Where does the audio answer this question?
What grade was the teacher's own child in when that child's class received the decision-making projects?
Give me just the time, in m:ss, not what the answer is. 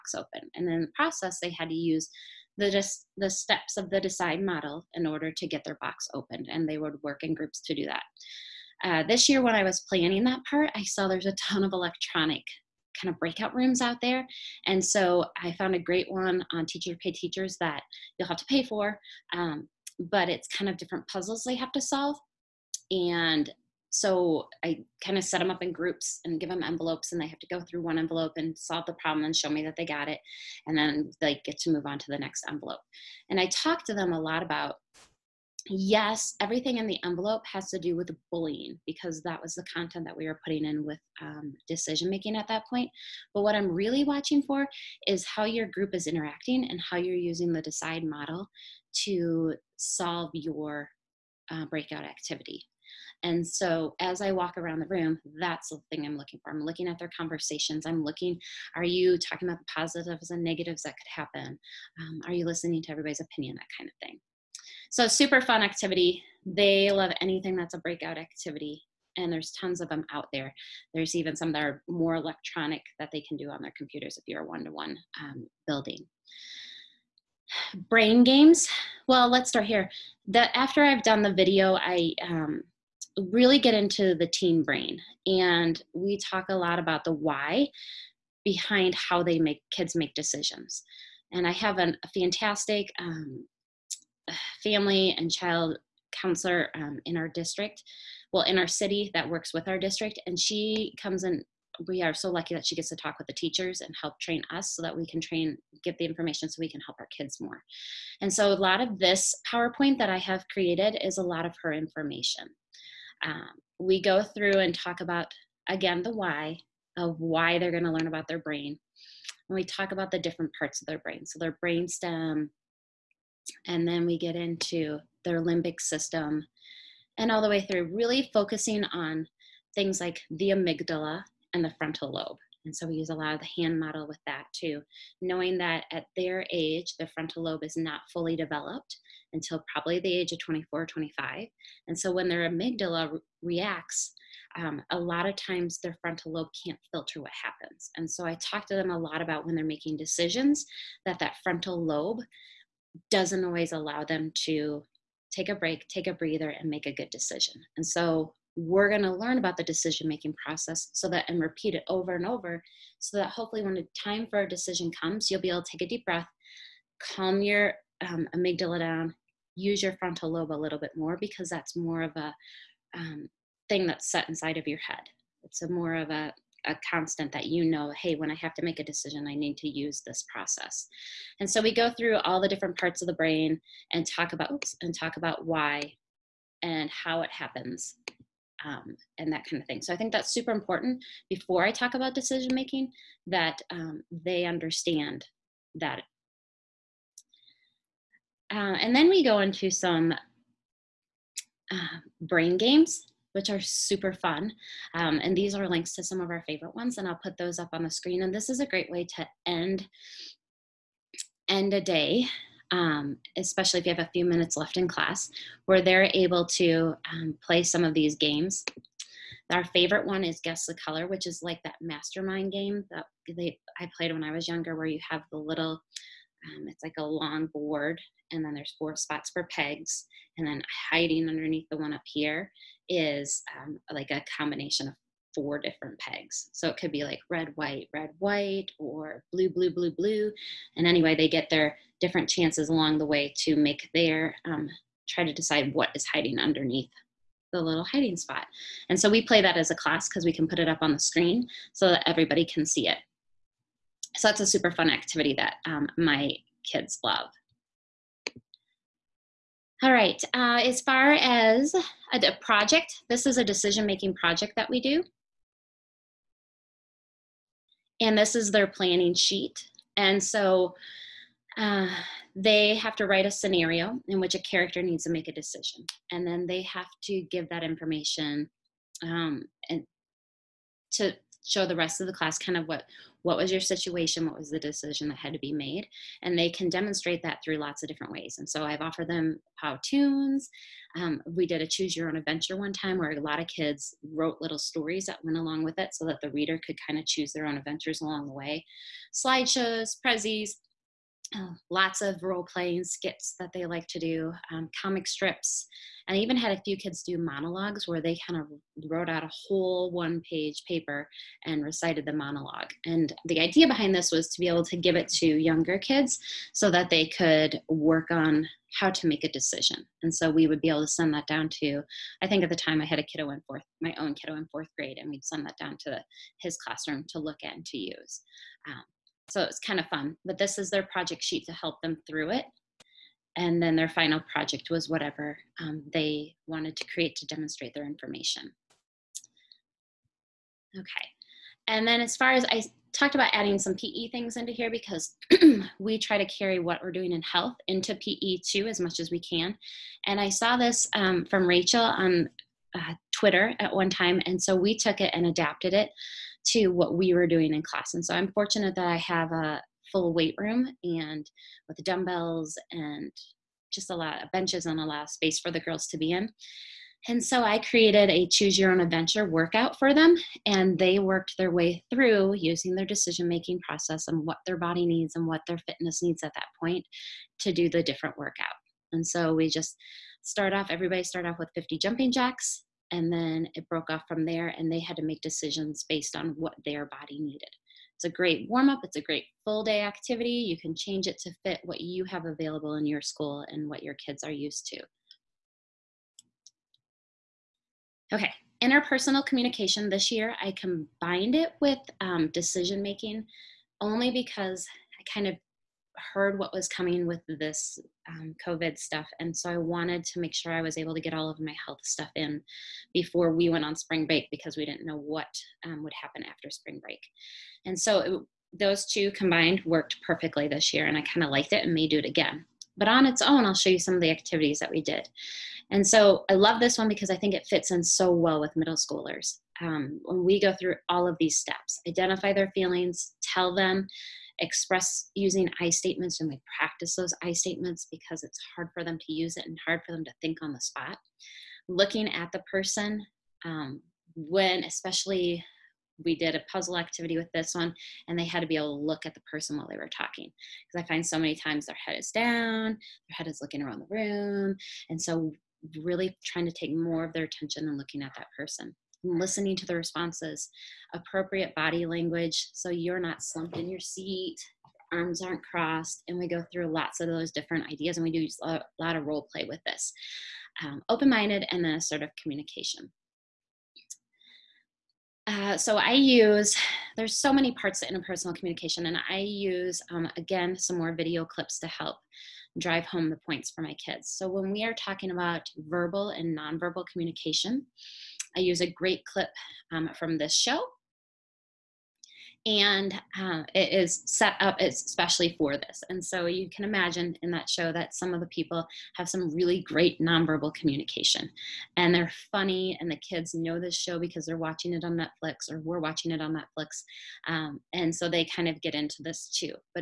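5:24.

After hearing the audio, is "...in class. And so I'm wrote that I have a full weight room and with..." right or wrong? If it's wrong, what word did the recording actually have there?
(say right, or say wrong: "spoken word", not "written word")
wrong: "fortunate", not "wrote".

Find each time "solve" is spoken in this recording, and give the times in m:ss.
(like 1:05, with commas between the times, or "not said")
0:21, 0:28, 0:49.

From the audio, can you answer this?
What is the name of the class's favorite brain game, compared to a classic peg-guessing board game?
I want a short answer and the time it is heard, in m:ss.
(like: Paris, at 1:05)
Guess the Color, at 3:40.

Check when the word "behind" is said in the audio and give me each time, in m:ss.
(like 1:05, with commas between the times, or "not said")
1:28, 5:13.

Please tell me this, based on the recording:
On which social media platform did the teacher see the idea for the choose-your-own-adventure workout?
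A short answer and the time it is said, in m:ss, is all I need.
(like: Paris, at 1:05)
Twitter, at 5:53.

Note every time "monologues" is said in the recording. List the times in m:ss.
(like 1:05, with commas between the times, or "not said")
5:07, 5:12.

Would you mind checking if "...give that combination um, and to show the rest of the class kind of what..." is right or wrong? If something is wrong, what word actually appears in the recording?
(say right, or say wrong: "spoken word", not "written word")
wrong: "information", not "combination".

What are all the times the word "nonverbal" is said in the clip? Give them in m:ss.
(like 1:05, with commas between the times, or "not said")
8:06, 8:19.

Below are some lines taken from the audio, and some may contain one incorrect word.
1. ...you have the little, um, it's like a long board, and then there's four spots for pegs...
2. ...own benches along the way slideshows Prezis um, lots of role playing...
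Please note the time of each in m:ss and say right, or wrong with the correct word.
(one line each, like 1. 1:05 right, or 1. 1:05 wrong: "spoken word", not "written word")
1. 3:44 right
2. 4:57 wrong: "adventures", not "benches".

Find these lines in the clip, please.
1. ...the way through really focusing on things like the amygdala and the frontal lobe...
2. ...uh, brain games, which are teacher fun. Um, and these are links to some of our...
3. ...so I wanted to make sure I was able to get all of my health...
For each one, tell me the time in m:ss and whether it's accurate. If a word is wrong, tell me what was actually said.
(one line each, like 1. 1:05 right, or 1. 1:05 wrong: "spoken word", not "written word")
1. 2:07 right
2. 3:21 wrong: "super", not "teacher"
3. 6:49 right.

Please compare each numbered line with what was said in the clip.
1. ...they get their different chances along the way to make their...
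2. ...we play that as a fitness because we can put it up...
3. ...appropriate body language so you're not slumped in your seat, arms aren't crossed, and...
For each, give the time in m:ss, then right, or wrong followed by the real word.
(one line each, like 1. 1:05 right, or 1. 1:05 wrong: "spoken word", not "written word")
1. 4:01 right
2. 4:09 wrong: "class", not "fitness"
3. 7:40 right.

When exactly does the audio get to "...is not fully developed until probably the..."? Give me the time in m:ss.
2:17.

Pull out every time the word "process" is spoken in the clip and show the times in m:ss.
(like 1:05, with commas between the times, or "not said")
0:00, 2:40, 3:00, 6:13.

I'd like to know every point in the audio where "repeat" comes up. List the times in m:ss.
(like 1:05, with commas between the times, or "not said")
2:41.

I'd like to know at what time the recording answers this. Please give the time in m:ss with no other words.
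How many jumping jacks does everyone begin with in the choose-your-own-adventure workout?
6:21.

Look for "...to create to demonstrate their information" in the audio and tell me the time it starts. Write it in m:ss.
5:36.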